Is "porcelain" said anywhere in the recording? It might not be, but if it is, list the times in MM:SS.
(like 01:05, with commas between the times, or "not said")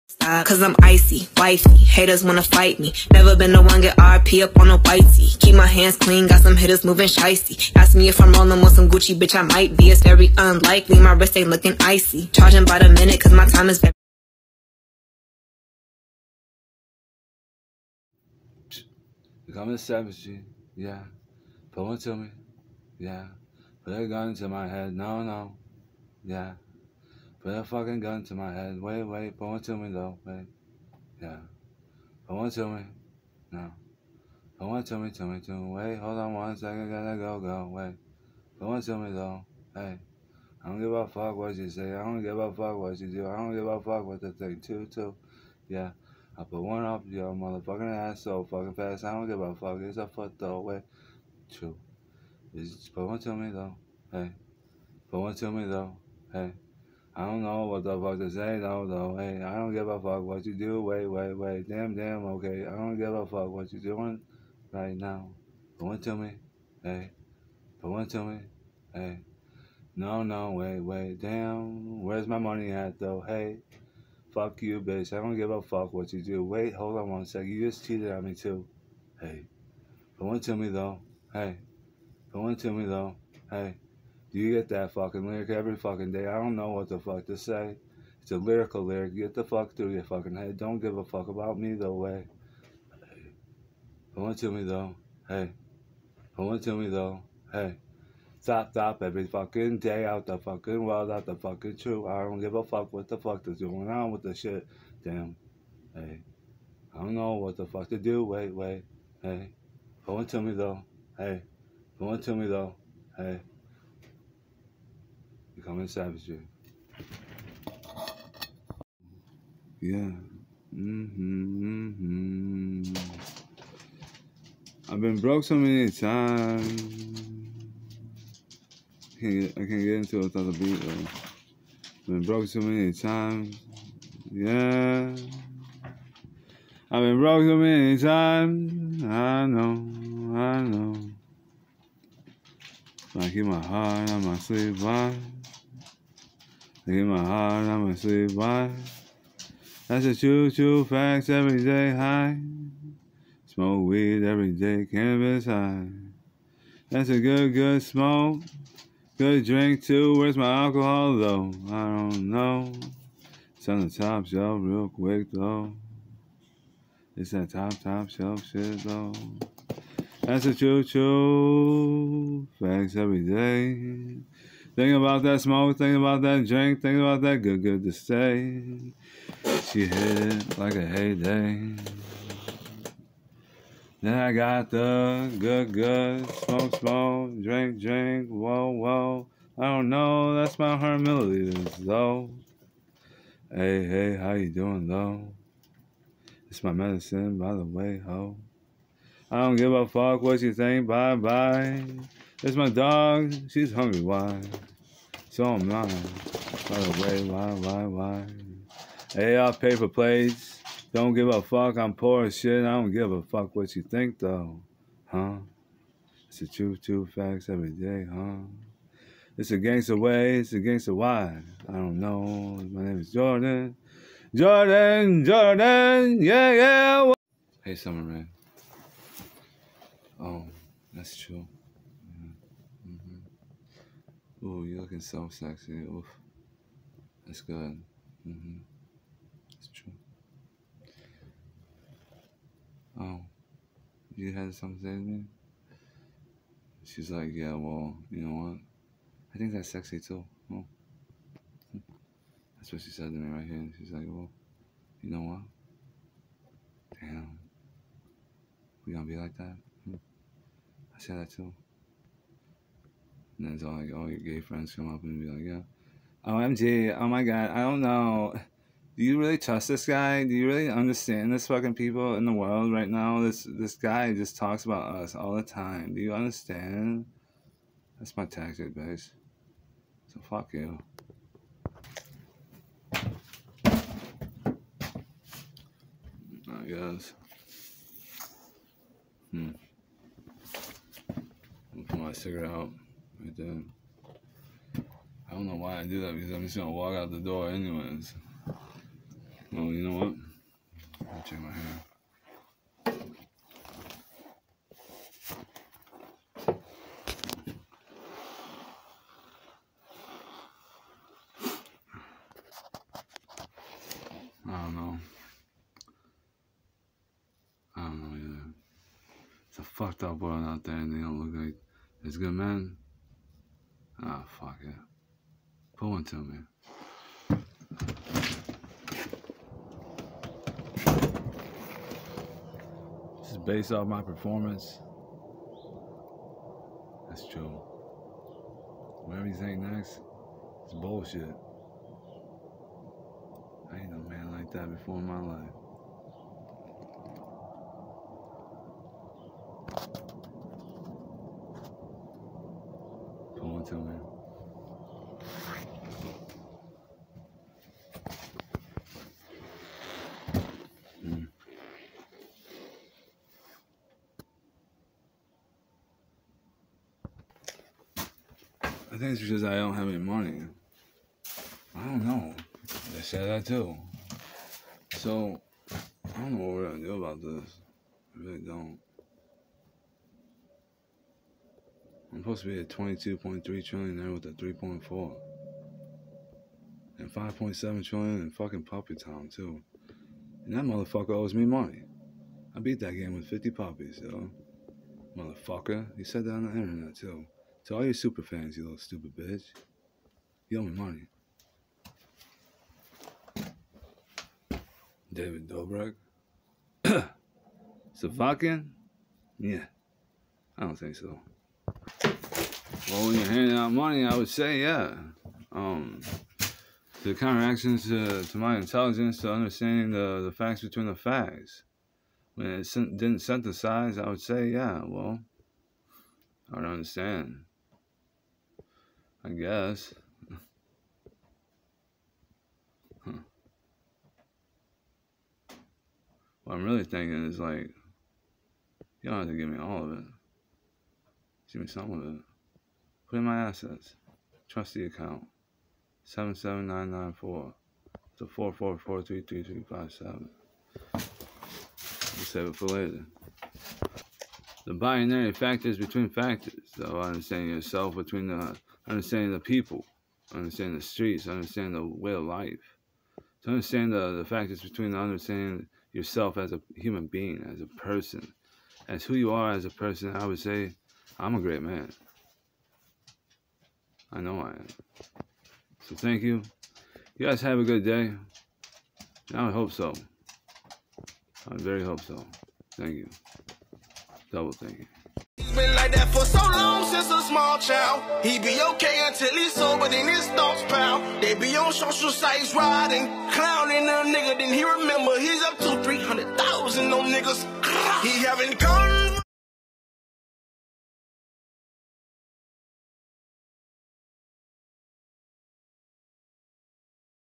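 not said.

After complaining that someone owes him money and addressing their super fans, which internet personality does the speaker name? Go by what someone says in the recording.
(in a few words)
David Dobrik.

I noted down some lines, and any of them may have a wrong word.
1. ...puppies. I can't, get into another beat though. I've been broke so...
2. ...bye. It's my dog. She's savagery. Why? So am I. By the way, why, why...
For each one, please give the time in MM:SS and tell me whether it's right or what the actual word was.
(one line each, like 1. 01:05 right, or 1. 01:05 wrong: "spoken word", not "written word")
1. 02:05 wrong: "times", not "puppies"
2. 03:21 wrong: "hungry", not "savagery".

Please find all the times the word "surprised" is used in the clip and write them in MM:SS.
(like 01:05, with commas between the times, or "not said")
not said.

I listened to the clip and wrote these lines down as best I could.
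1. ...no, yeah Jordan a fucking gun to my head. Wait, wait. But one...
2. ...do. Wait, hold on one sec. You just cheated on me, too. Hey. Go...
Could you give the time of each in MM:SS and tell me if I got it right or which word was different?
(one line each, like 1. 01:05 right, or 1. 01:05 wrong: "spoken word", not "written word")
1. 00:25 wrong: "Put", not "Jordan"
2. 01:16 right.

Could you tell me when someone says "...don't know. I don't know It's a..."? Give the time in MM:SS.
05:14.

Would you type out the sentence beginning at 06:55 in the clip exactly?
Um, the counteractions to, uh, to my intelligence, to understanding the, the facts between the facts.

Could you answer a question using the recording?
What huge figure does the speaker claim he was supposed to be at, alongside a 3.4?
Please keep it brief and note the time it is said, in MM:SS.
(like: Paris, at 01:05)
22.3 trillion, at 06:22.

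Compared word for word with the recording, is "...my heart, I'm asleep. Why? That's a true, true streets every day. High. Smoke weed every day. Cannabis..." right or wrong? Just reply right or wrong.
wrong.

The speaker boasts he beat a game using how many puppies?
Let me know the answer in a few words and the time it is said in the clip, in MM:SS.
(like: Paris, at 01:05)
50, at 06:33.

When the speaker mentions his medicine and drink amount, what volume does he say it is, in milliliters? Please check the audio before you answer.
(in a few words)
100 milliliters.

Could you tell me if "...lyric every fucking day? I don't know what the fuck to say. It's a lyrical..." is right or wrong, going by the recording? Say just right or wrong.
right.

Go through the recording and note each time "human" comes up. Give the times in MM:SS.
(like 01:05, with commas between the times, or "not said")
07:46.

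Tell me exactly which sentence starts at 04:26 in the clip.
OMG, oh, oh my god, I don't know.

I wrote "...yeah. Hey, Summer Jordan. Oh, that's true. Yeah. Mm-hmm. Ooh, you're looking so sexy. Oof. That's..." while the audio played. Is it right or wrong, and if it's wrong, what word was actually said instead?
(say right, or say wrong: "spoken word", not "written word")
wrong: "Man", not "Jordan".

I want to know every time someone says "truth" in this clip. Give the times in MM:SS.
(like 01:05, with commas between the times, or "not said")
01:41, 03:36.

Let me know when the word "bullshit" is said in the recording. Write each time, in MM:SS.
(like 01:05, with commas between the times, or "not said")
05:40.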